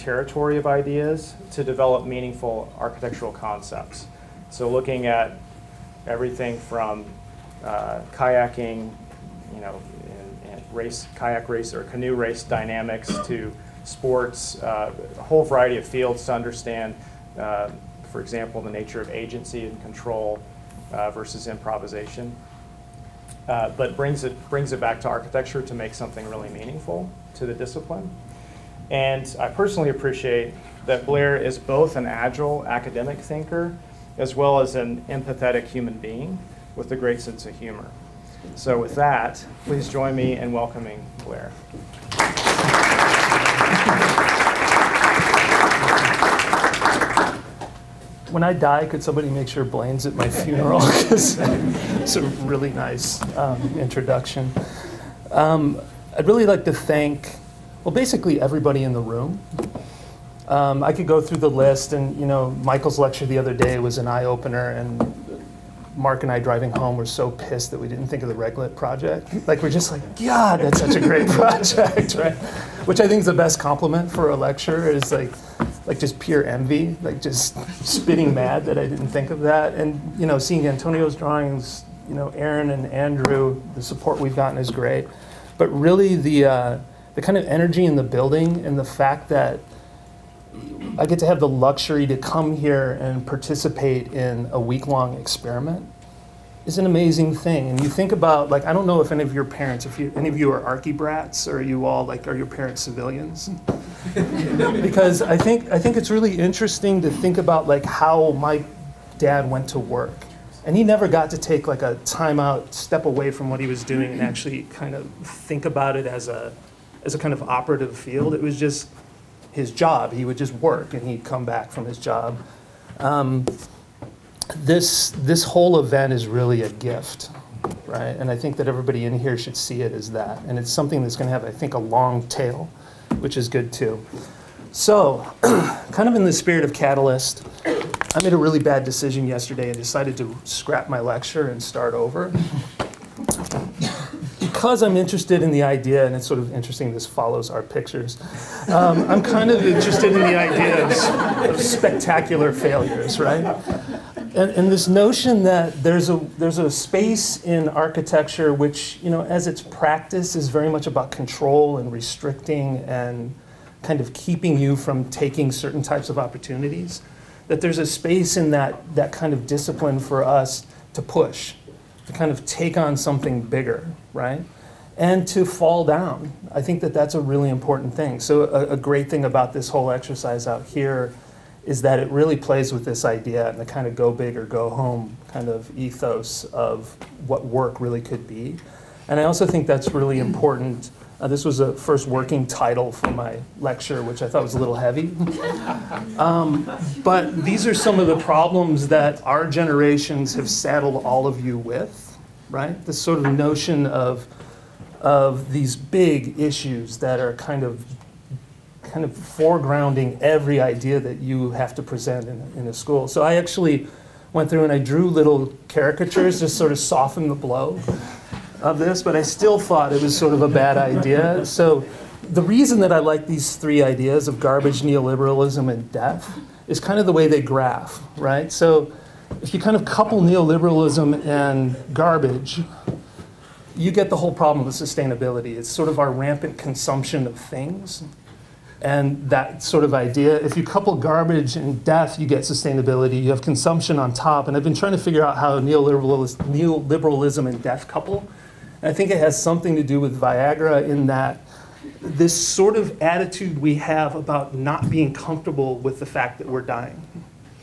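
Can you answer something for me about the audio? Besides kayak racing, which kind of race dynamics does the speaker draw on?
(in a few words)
Canoe race.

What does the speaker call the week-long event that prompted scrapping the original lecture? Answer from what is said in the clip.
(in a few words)
Catalyst.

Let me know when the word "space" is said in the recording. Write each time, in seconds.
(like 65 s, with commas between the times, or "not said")
156 s, 167 s.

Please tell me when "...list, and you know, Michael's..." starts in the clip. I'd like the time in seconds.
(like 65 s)
61 s.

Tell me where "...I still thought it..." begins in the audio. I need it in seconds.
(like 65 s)
219 s.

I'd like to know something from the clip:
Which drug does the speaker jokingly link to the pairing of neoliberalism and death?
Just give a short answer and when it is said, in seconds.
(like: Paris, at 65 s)
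Viagra, at 250 s.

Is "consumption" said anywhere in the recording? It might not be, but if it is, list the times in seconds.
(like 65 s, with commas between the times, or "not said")
236 s, 243 s.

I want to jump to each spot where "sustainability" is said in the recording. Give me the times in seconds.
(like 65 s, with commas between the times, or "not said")
234 s, 242 s.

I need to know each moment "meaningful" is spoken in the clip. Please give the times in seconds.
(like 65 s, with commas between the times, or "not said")
2 s, 26 s.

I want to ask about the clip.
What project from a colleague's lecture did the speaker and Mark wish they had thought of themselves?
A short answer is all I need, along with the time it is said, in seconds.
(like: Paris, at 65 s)
Reglet project, at 68 s.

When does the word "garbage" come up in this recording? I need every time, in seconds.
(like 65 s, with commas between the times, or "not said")
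224 s, 231 s, 240 s.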